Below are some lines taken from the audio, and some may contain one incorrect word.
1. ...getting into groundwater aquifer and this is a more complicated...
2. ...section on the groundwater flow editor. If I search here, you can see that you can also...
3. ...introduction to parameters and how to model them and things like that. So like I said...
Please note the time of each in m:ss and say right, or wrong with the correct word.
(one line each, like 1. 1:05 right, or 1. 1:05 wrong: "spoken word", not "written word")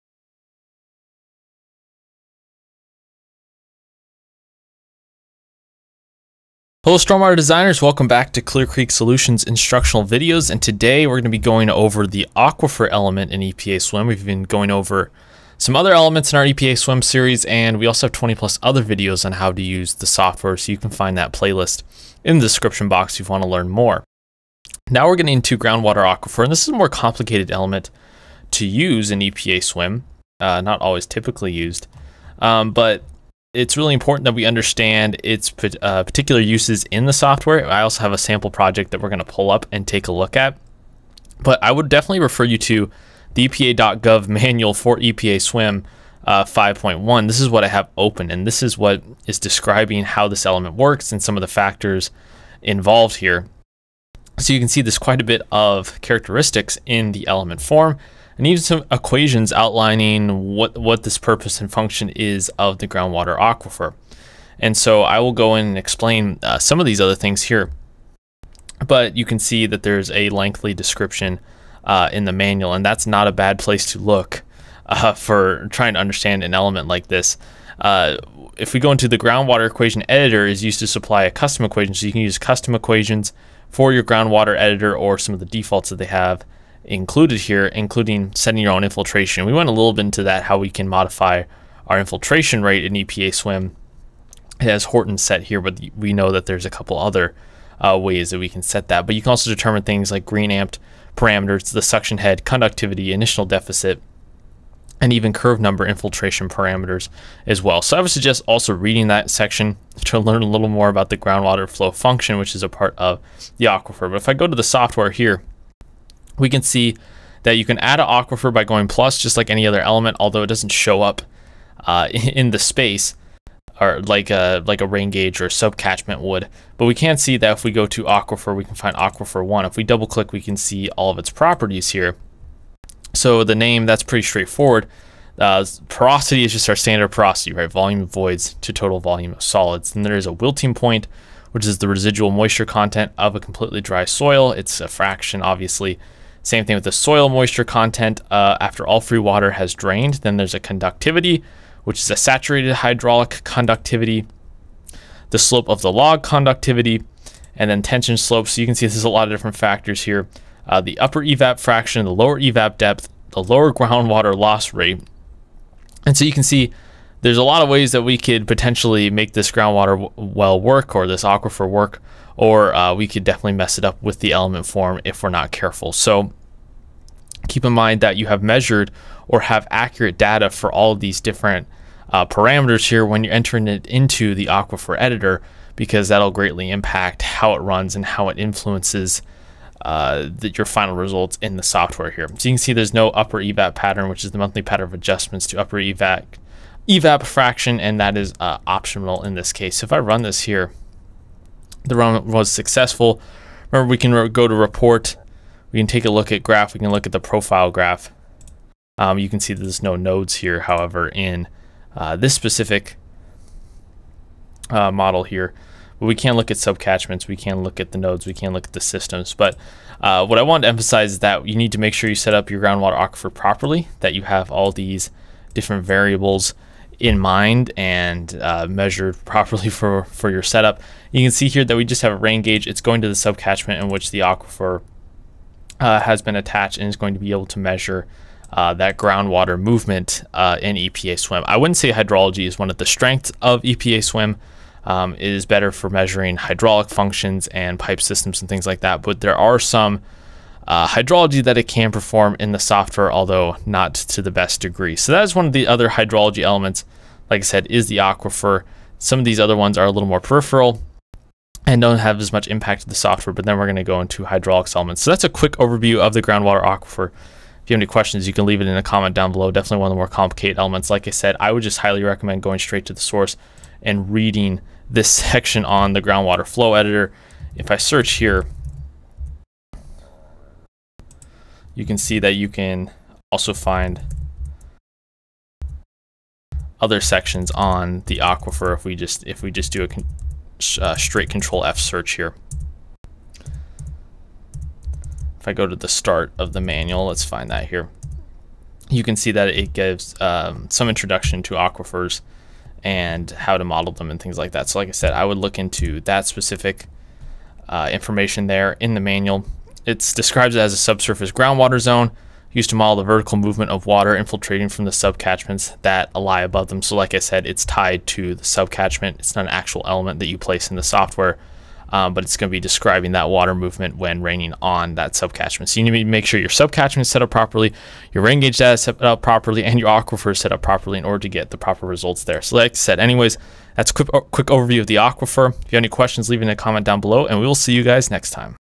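1. 0:25 right
2. 4:35 right
3. 5:00 wrong: "aquifers", not "parameters".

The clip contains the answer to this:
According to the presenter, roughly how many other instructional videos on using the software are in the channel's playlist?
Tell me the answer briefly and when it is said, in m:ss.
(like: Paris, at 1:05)
20 plus, at 0:18.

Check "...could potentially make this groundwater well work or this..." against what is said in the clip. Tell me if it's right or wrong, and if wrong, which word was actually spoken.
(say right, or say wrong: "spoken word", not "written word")
right.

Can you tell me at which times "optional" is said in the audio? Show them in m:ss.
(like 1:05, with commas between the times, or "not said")
3:18.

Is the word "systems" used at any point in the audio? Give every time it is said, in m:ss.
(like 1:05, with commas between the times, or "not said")
3:38, 4:08.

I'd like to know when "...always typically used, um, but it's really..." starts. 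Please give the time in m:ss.
0:30.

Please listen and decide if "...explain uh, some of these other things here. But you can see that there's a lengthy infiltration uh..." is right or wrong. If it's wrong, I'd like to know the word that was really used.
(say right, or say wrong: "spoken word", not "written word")
wrong: "description", not "infiltration".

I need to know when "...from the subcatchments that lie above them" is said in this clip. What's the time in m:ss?
5:14.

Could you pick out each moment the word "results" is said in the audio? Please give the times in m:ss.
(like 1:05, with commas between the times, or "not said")
3:10, 5:31.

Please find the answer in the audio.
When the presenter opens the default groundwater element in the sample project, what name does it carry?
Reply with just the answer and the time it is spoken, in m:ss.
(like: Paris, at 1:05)
aquifer one, at 2:08.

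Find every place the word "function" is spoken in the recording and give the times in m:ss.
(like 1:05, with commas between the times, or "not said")
1:01, 1:51, 4:06.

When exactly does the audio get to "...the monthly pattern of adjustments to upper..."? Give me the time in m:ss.
3:14.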